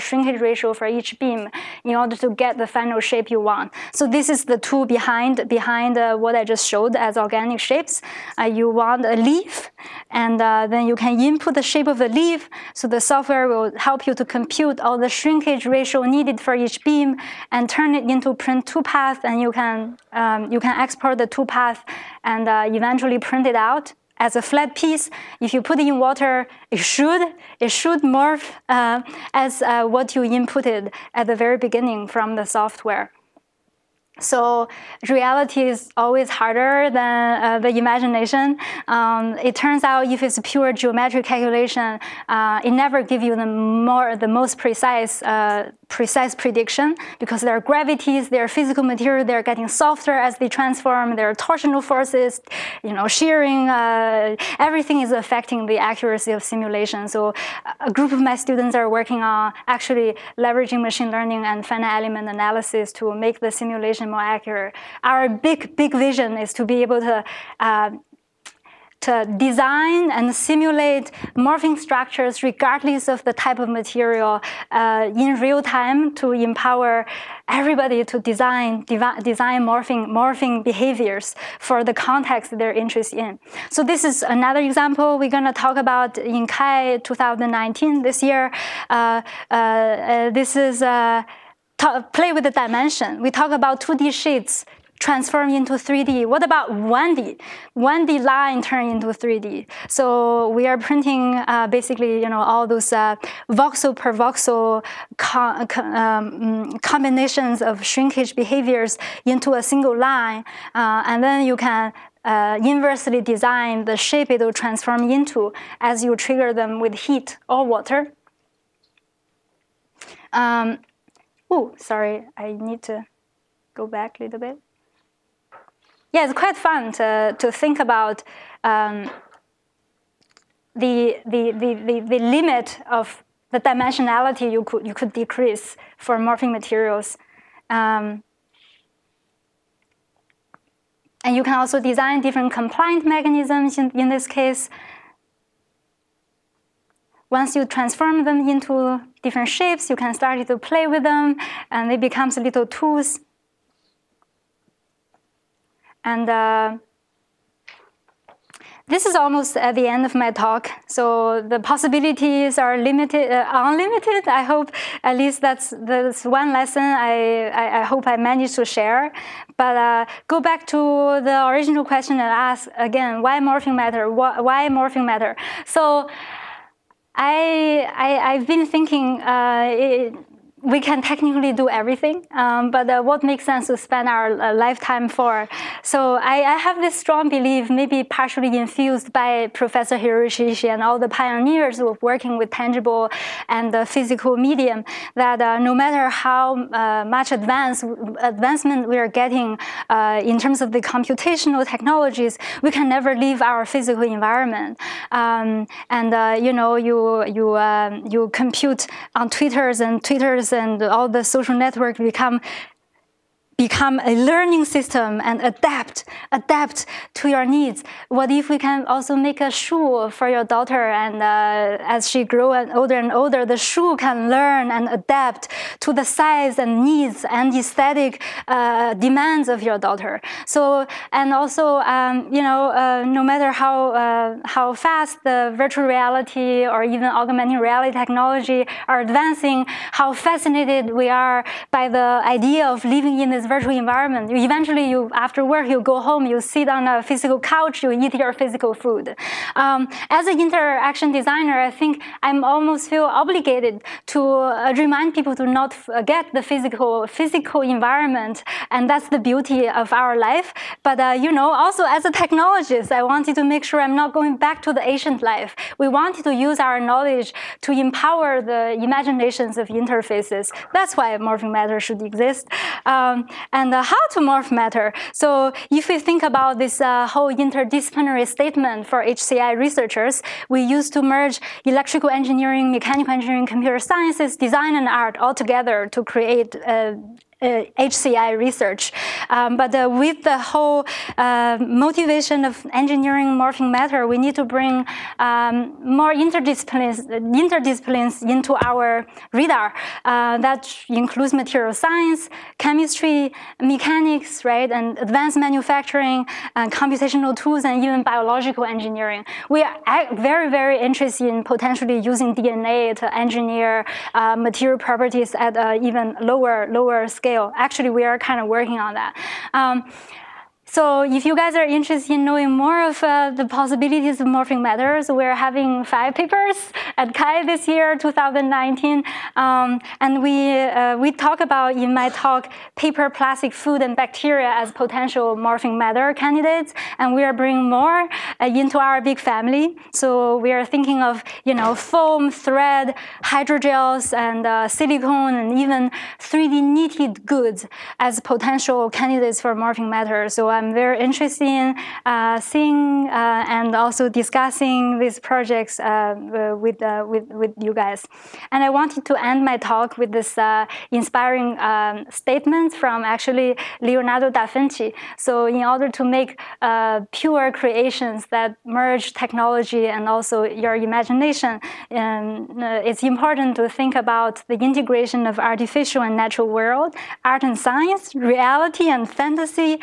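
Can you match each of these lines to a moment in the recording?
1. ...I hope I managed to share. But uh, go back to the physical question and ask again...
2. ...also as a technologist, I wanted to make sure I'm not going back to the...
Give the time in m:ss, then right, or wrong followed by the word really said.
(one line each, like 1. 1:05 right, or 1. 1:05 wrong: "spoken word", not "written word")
1. 2:47 wrong: "original", not "physical"
2. 4:21 right.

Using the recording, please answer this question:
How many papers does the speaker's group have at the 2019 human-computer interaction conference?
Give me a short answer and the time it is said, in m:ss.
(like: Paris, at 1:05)
5, at 5:25.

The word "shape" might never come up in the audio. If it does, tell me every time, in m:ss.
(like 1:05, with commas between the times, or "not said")
0:03, 0:07, 0:11, 1:53, 2:29.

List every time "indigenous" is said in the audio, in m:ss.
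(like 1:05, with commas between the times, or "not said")
not said.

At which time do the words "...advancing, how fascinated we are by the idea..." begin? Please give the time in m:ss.
3:59.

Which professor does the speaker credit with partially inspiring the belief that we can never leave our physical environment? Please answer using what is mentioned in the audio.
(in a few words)
Professor Hiroshi.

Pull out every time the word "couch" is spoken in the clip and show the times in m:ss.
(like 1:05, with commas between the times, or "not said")
4:07.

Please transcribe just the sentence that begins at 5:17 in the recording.
Actually, we are kind of working on that.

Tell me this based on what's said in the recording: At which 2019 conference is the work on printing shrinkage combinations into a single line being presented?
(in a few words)
CHI 2019.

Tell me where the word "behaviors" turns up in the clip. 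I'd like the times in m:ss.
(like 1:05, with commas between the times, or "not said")
1:20, 1:48.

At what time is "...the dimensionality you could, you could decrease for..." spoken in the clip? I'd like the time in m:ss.
2:13.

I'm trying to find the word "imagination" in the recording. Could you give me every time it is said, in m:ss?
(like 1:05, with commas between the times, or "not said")
0:37, 4:28, 6:10.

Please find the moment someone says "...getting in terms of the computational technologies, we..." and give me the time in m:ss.
3:19.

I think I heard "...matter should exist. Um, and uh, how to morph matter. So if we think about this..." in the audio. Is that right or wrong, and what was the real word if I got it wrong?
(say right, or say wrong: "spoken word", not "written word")
right.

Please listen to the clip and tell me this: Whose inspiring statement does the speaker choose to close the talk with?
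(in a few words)
Leonardo da Vinci.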